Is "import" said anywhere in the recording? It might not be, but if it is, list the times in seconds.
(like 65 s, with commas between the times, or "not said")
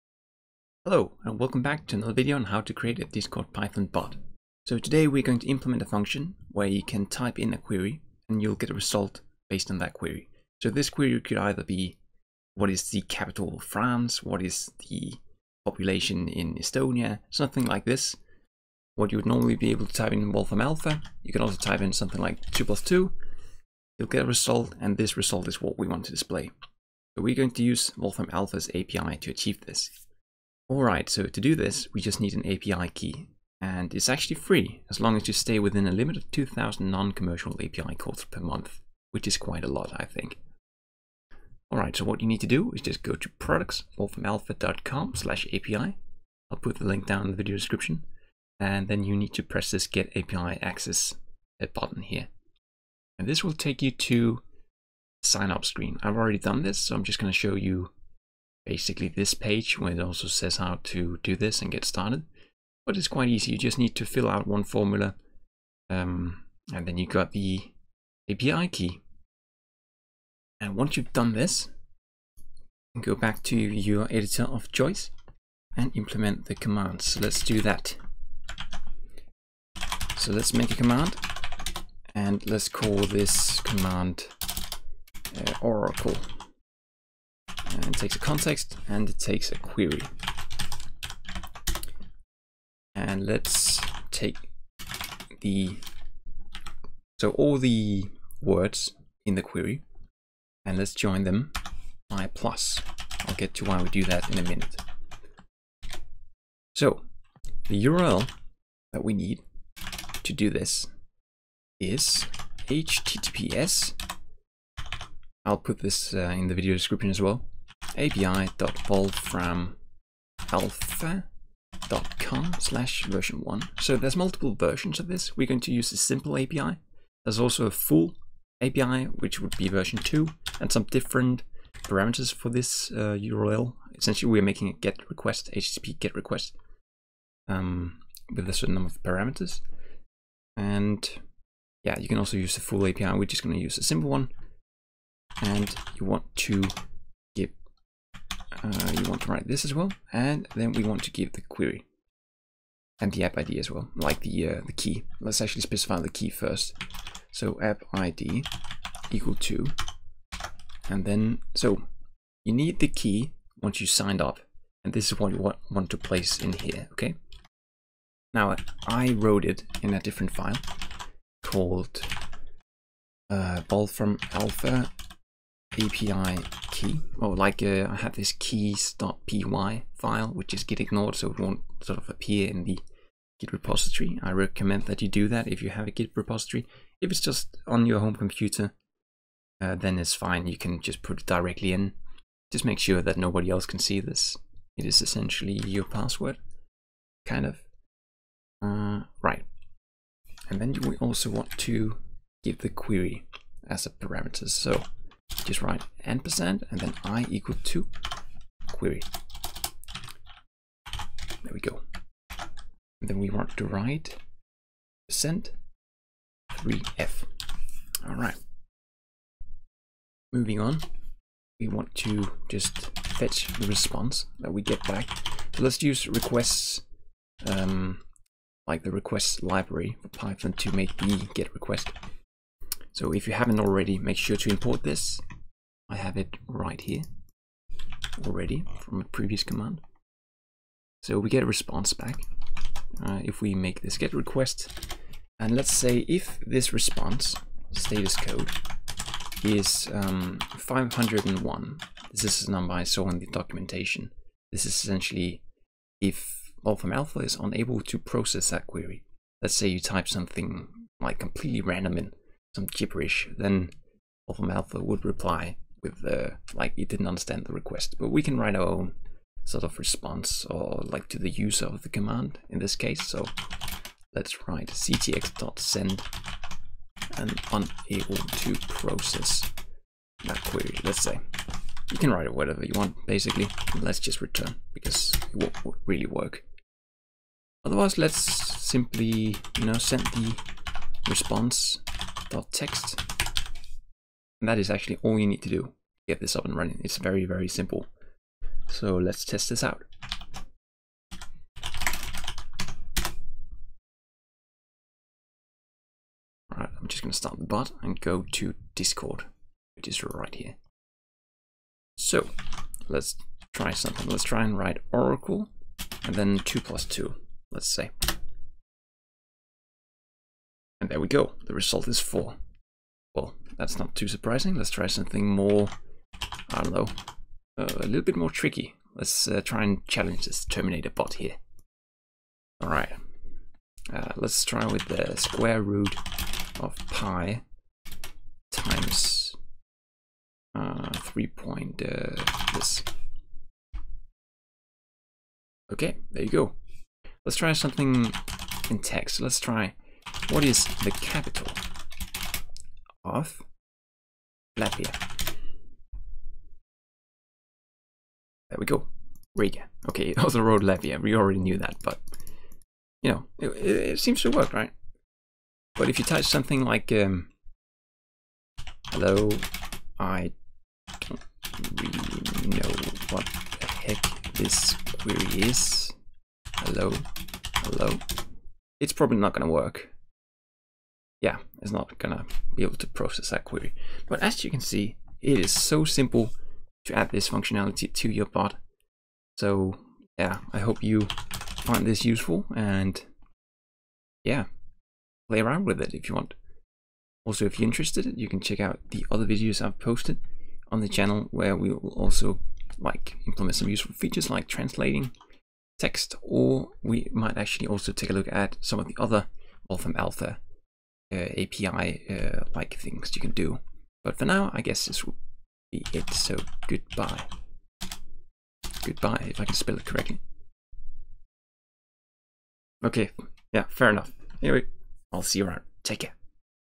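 234 s.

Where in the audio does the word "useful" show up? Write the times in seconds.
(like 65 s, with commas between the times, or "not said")
392 s, 403 s.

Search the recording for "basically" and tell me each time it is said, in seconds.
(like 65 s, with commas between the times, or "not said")
58 s, 283 s.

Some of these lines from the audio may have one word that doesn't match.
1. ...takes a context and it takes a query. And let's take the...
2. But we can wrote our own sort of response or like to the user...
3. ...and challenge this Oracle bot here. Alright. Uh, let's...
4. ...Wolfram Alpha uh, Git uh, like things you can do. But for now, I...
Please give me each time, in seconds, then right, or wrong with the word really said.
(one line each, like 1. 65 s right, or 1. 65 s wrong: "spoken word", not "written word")
1. 87 s right
2. 267 s wrong: "write", not "wrote"
3. 329 s wrong: "Terminator", not "Oracle"
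4. 409 s wrong: "API", not "Git".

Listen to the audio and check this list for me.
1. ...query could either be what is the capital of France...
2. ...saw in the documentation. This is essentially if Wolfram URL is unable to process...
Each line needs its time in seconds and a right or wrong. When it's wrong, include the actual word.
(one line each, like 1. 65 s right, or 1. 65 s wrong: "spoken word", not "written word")
1. 10 s right
2. 252 s wrong: "Alpha", not "URL".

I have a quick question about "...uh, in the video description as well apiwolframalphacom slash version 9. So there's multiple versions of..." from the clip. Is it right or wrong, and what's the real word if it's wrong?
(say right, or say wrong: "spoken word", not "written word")
wrong: "1", not "9".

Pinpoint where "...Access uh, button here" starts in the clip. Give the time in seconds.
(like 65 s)
50 s.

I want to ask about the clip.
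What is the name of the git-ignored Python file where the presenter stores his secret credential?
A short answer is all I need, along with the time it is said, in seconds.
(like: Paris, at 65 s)
keys.py, at 178 s.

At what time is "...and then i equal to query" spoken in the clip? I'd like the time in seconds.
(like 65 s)
206 s.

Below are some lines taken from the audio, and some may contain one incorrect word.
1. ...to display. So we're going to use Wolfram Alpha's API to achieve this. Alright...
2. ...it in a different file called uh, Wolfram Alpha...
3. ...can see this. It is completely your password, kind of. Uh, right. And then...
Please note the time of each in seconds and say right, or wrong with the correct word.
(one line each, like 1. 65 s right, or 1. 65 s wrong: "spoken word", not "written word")
1. 26 s right
2. 169 s right
3. 193 s wrong: "essentially", not "completely".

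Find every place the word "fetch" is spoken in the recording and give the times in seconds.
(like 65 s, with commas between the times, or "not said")
223 s.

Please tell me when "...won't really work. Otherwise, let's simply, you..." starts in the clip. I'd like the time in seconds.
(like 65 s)
285 s.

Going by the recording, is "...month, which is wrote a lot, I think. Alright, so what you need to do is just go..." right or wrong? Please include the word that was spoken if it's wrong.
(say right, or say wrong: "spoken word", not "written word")
wrong: "quite", not "wrote".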